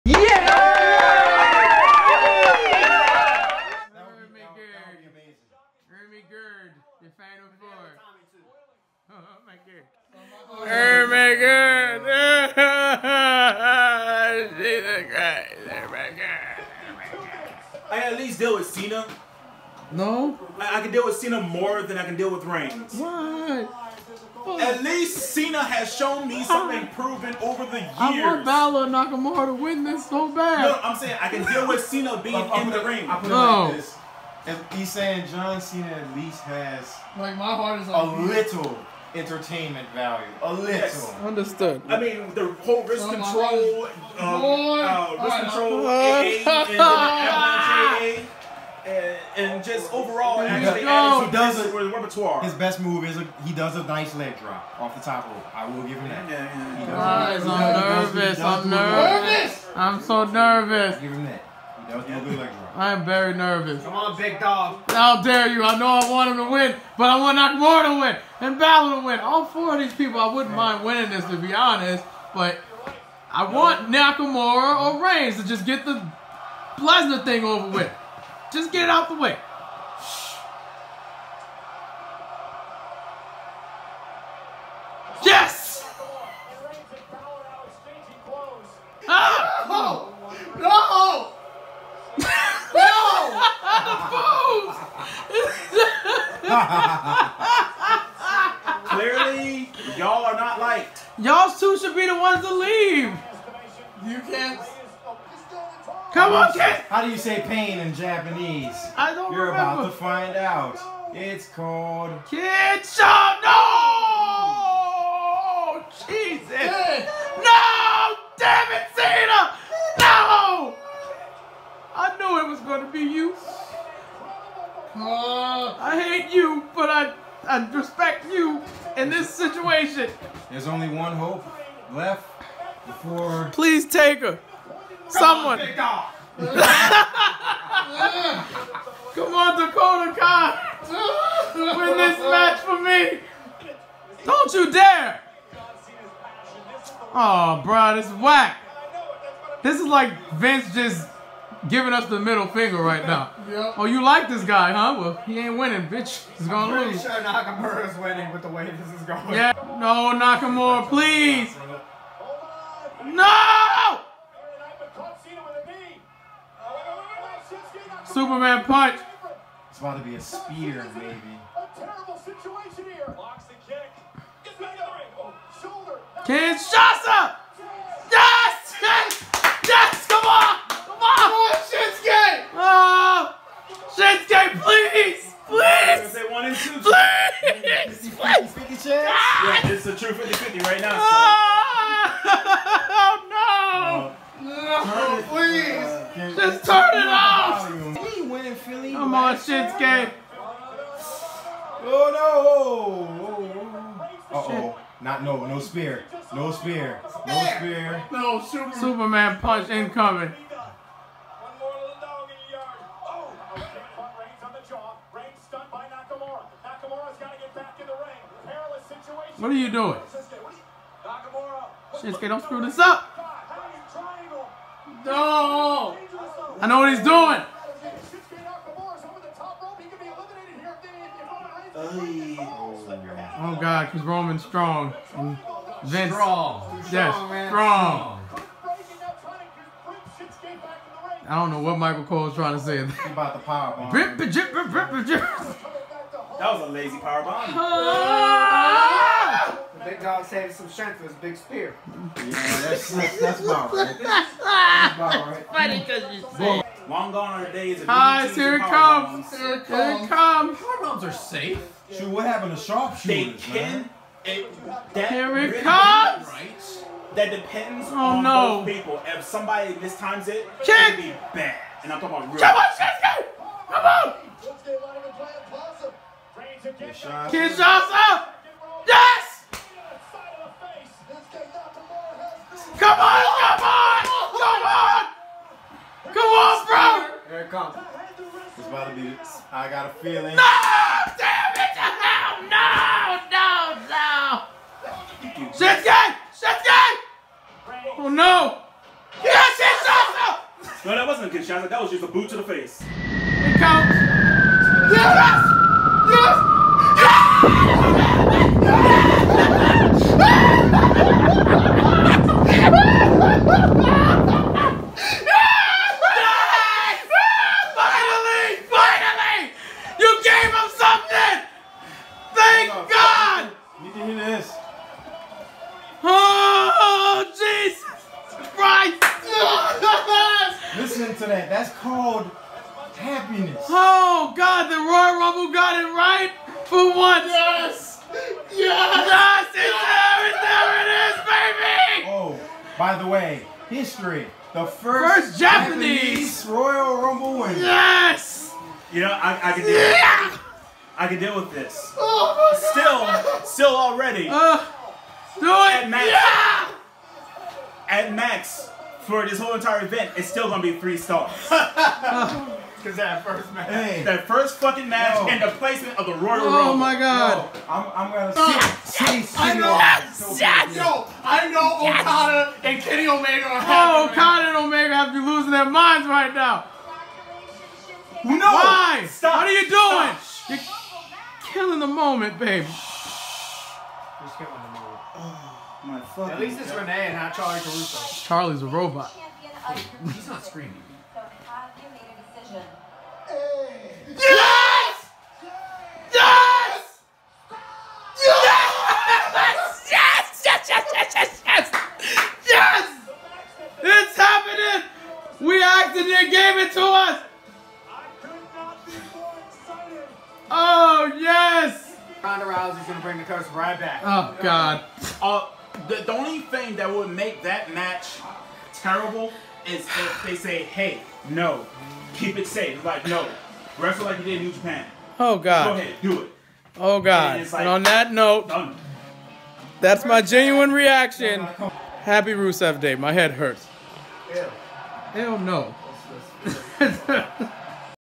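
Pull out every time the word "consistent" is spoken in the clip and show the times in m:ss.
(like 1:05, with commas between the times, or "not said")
not said.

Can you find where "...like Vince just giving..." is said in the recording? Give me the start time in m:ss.
2:29.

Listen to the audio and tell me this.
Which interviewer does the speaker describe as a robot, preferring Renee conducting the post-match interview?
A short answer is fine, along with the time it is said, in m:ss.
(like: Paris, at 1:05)
Charly Caruso, at 6:27.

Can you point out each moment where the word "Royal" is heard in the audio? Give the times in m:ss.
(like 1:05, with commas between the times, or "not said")
5:34, 5:46, 6:06.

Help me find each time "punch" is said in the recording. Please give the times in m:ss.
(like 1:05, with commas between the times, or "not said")
2:48, 3:29.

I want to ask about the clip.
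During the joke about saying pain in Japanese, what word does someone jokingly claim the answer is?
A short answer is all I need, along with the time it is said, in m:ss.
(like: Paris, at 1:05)
Kitchen, at 1:52.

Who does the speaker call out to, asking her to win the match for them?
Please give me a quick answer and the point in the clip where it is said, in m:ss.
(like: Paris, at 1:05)
Dakota Kai, at 2:19.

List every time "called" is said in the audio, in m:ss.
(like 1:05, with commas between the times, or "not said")
1:51, 5:31.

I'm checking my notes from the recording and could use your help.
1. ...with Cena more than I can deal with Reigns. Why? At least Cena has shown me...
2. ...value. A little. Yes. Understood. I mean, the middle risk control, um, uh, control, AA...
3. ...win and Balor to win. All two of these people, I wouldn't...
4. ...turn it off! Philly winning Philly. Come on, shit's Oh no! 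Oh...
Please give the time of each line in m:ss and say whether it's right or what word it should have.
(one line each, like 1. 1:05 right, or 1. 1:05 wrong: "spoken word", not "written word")
1. 0:21 right
2. 0:39 wrong: "whole", not "middle"
3. 1:07 wrong: "four", not "two"
4. 3:16 right.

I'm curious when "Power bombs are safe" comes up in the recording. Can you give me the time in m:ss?
4:20.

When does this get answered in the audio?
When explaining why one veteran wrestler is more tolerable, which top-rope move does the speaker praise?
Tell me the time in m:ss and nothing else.
0:54.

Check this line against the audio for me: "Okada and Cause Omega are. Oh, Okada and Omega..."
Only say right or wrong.
wrong.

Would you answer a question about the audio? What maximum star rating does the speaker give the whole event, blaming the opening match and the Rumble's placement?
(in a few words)
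3 stars.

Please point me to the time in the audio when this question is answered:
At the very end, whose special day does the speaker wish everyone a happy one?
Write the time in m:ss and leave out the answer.
7:12.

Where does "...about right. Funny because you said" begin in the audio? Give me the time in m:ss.
4:14.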